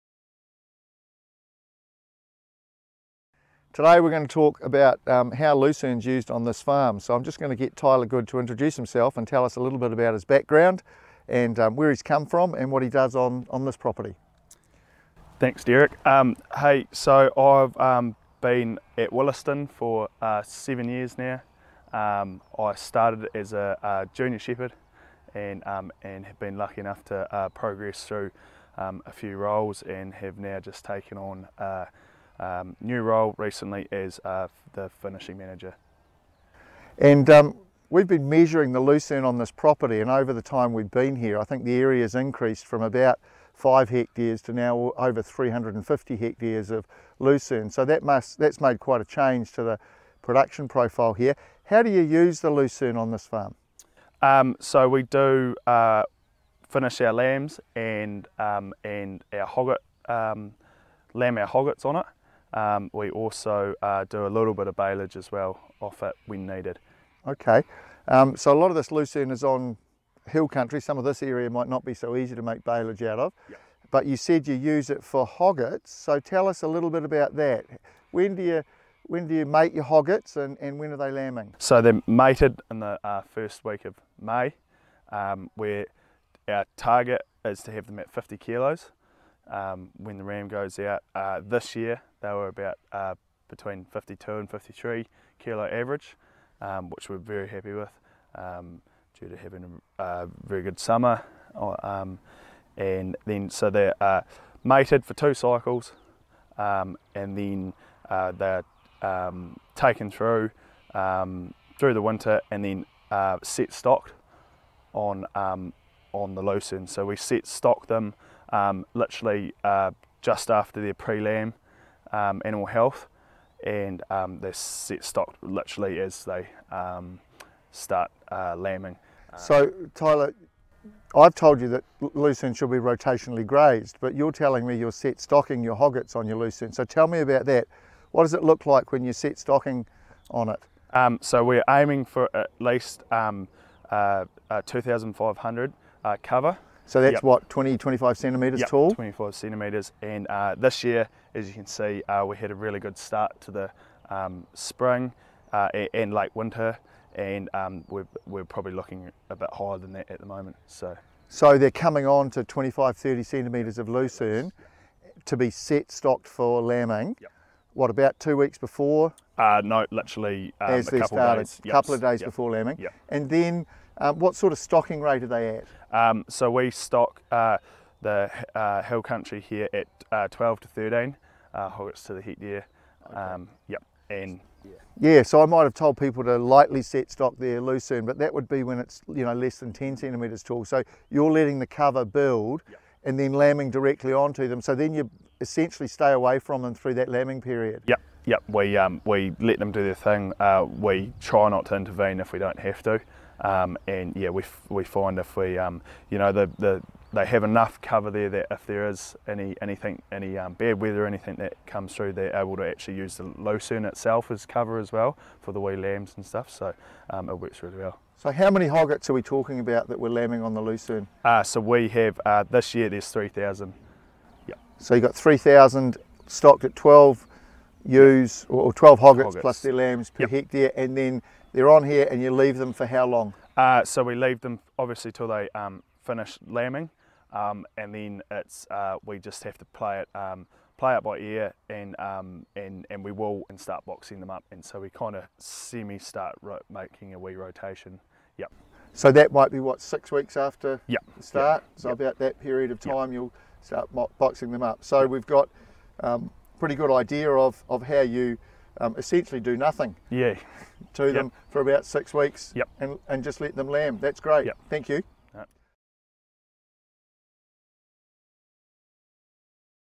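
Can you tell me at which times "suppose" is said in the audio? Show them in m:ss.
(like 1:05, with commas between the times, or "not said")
not said.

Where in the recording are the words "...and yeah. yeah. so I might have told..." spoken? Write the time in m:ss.
3:04.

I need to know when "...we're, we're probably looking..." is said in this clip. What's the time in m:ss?
2:37.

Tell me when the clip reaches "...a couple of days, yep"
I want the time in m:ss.
2:51.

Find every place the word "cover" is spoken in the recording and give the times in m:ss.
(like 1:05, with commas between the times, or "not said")
2:26, 3:11, 3:27, 3:34.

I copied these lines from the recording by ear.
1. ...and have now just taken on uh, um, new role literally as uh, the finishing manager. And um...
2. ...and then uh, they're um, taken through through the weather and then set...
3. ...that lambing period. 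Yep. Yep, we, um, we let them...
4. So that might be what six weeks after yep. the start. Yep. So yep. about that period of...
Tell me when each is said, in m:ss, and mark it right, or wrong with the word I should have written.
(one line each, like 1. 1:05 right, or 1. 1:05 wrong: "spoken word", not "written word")
1. 0:29 wrong: "recently", not "literally"
2. 1:47 wrong: "winter", not "weather"
3. 3:16 right
4. 4:08 right.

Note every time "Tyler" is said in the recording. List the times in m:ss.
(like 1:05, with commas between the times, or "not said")
0:07, 2:09.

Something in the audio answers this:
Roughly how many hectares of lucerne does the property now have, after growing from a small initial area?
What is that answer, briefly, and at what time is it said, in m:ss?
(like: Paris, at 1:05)
over 350 hectares, at 0:44.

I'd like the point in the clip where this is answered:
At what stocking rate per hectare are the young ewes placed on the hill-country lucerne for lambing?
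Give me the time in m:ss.
3:00.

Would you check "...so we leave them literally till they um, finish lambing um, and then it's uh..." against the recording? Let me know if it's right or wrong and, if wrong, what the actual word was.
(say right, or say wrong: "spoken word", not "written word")
wrong: "obviously", not "literally".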